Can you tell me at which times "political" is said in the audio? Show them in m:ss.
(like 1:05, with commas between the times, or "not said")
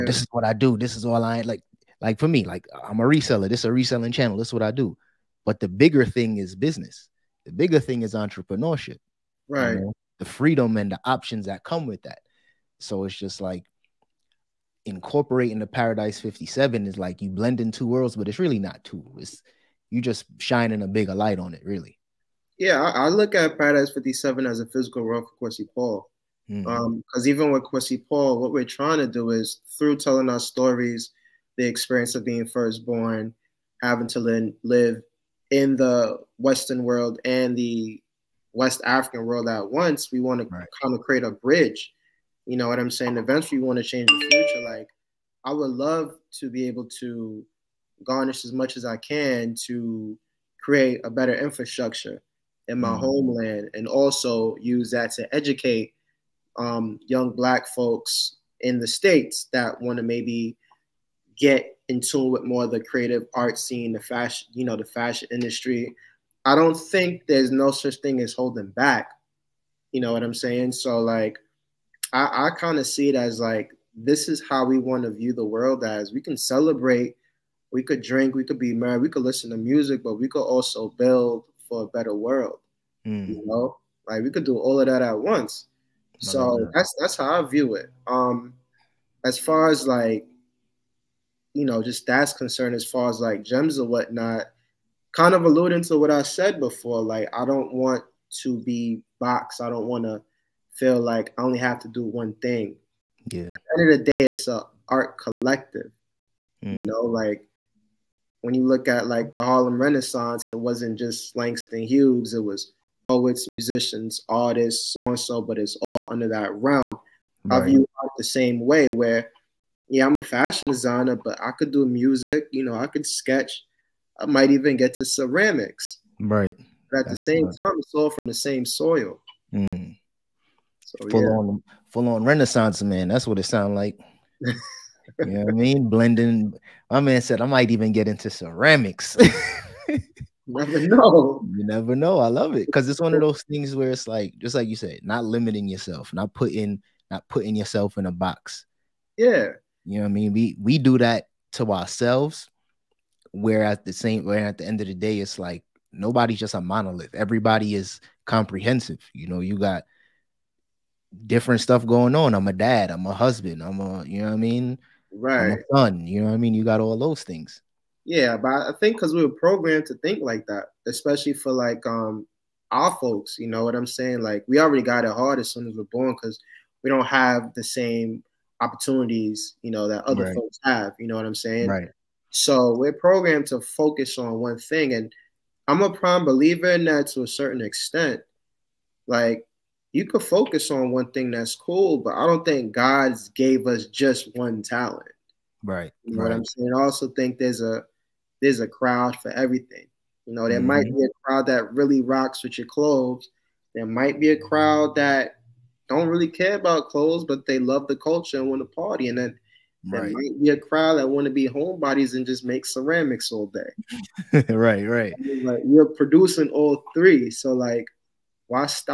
not said.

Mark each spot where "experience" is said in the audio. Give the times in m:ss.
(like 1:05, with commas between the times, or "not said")
0:31.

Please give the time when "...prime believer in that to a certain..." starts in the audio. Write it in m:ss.
3:05.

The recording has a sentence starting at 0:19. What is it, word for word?
It's you just shining a bigger light on it, really.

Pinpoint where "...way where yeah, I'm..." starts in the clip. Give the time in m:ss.
1:58.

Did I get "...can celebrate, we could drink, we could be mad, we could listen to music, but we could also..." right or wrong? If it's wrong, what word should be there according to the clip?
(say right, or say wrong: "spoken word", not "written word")
right.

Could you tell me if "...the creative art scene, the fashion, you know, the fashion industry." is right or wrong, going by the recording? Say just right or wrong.
right.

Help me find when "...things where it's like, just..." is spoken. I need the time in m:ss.
2:23.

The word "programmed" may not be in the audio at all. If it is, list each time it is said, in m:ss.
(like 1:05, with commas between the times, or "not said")
2:49, 3:02.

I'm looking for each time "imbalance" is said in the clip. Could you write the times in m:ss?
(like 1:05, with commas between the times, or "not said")
not said.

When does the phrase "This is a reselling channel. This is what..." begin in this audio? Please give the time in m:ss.
0:03.